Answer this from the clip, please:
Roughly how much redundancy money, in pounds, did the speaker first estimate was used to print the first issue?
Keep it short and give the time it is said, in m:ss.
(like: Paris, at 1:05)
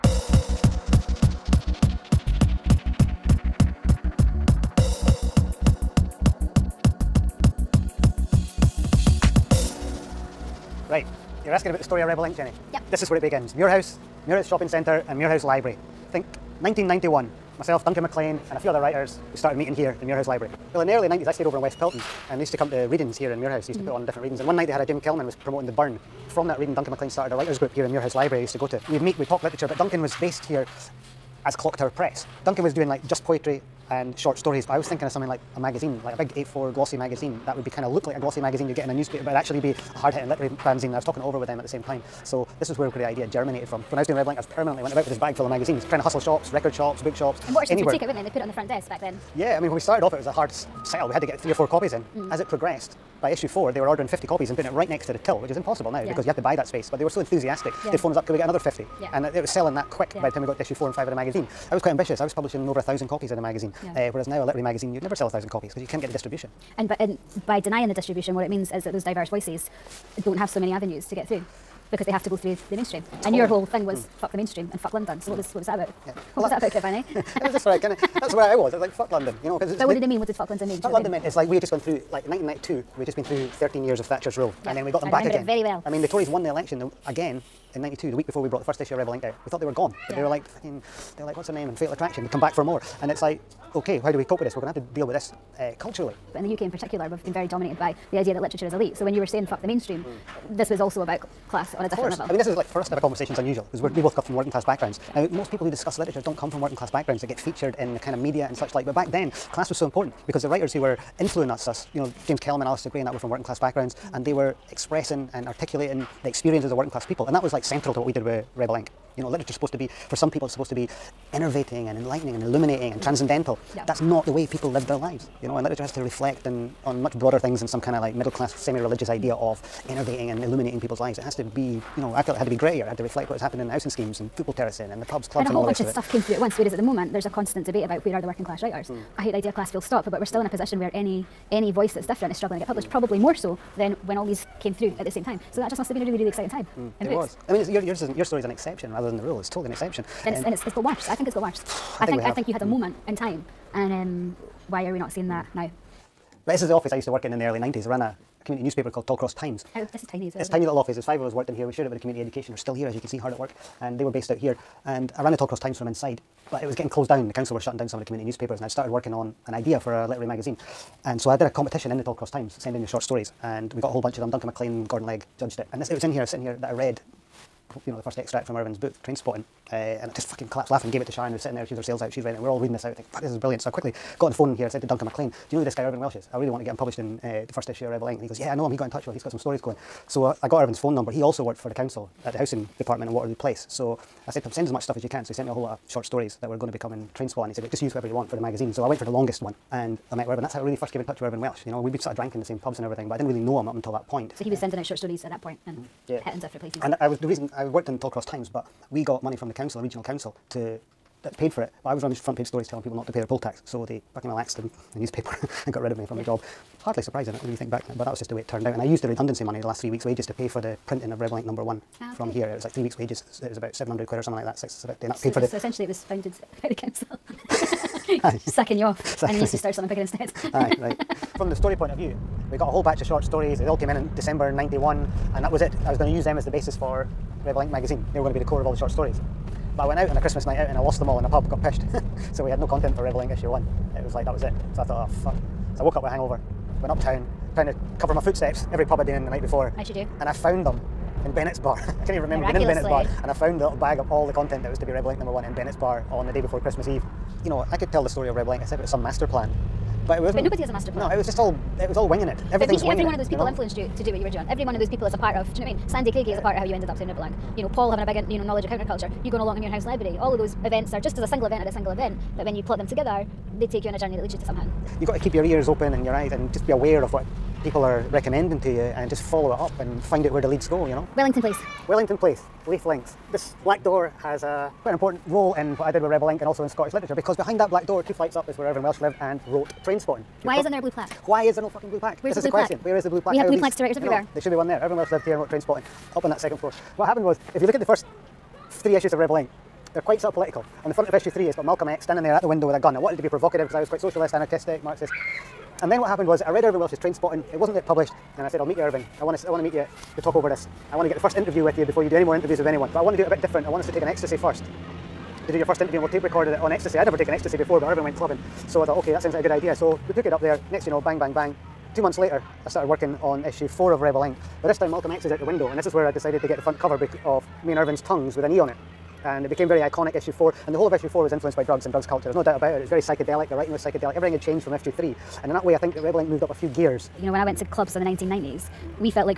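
700, at 3:43.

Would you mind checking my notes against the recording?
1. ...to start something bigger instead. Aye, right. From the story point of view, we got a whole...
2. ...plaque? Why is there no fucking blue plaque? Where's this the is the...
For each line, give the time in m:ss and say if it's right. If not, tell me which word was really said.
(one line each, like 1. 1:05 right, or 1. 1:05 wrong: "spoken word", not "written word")
1. 3:49 right
2. 4:50 right.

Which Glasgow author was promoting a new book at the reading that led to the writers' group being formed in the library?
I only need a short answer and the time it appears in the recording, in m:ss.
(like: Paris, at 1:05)
Jim Kelman, at 0:24.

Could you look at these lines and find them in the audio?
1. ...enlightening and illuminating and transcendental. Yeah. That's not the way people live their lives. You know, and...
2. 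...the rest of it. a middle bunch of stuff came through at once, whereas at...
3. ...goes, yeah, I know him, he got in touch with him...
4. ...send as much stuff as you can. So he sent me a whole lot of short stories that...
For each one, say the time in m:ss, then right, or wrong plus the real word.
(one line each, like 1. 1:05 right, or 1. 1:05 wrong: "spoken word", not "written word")
1. 2:01 right
2. 2:15 wrong: "whole", not "middle"
3. 3:08 right
4. 3:14 right.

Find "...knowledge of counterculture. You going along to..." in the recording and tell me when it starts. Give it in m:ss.
4:28.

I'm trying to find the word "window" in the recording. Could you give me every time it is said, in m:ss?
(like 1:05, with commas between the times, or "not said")
5:02, 5:25.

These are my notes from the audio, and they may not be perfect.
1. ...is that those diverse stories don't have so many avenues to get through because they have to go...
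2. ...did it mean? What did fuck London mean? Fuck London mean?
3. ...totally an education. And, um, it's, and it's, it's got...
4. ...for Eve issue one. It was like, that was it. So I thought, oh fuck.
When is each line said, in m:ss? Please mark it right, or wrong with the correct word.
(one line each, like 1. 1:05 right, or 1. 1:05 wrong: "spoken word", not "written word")
1. 1:08 wrong: "voices", not "stories"
2. 1:19 right
3. 2:29 wrong: "exception", not "education"
4. 4:02 wrong: "Rebel", not "Eve".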